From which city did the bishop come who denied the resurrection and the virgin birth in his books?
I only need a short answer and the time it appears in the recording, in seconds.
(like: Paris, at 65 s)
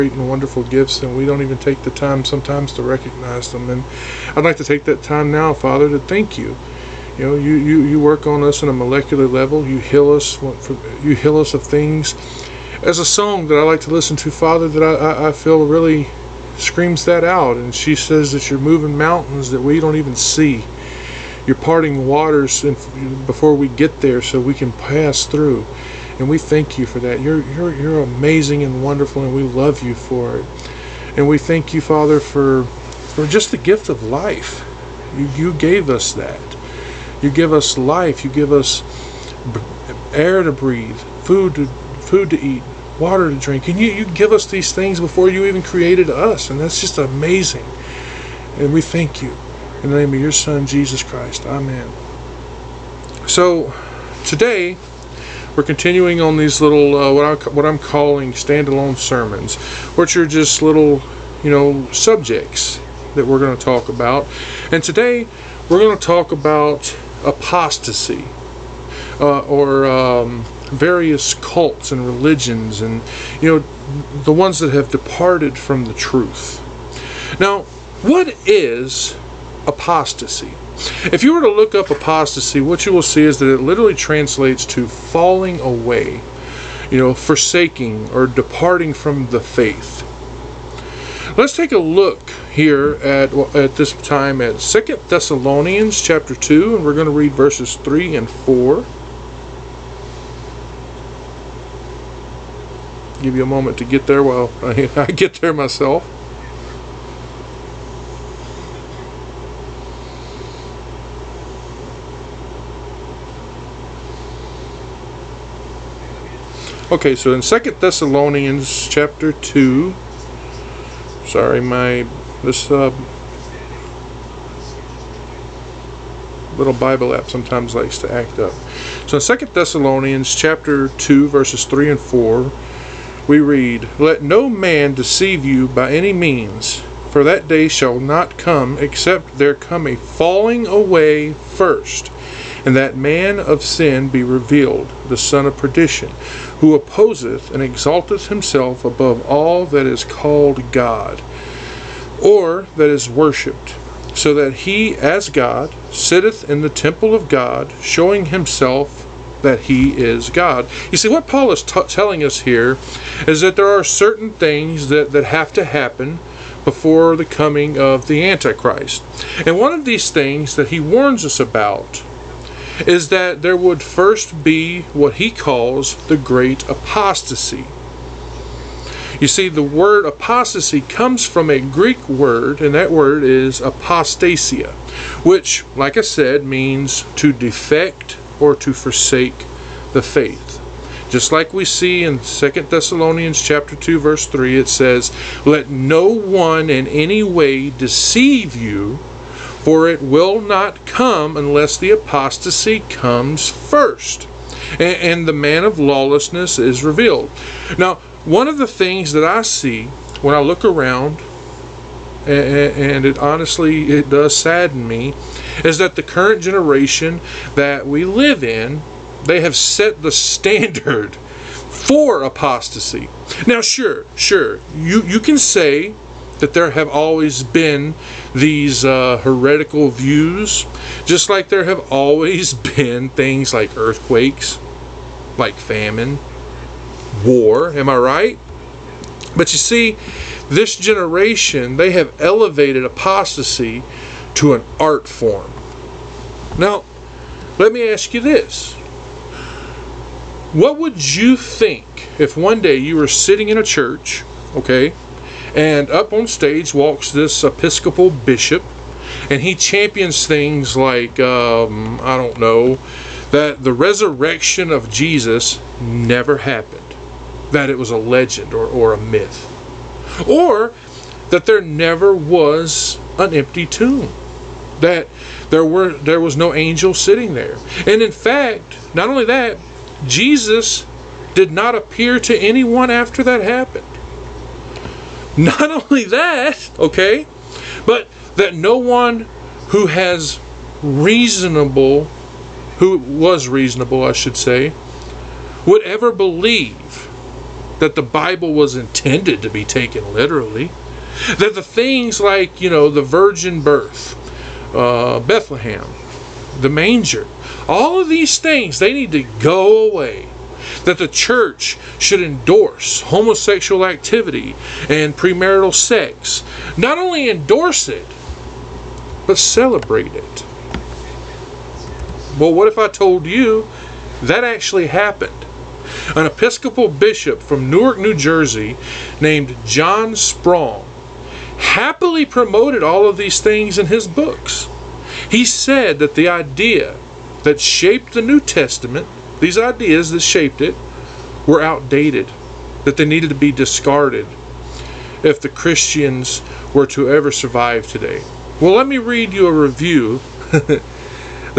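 Newark, New Jersey, at 327 s.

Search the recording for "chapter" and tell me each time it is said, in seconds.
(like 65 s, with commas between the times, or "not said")
96 s, 118 s, 130 s, 193 s.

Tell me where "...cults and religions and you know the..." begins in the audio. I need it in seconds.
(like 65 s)
71 s.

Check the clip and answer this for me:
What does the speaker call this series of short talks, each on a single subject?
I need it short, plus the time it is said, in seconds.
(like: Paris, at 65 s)
standalone sermons, at 58 s.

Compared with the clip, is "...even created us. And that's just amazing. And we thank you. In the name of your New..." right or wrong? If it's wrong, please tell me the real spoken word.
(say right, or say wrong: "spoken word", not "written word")
wrong: "Son", not "New".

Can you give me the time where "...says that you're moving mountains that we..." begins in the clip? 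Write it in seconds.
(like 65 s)
17 s.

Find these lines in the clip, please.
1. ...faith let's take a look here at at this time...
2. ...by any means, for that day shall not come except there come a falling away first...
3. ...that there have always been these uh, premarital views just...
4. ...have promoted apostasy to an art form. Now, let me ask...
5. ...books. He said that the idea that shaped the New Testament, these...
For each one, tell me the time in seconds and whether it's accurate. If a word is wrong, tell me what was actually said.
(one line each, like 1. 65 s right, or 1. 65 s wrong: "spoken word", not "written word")
1. 89 s right
2. 135 s right
3. 226 s wrong: "heretical", not "premarital"
4. 241 s wrong: "elevated", not "promoted"
5. 334 s right.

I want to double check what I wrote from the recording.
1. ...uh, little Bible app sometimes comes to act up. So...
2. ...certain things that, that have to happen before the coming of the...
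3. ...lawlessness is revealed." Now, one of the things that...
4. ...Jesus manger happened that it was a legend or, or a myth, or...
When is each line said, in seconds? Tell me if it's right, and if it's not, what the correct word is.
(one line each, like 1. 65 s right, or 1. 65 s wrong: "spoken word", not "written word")
1. 122 s wrong: "likes", not "comes"
2. 163 s right
3. 205 s right
4. 264 s wrong: "never", not "manger".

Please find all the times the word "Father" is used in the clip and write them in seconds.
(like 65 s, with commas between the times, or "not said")
5 s, 14 s, 31 s.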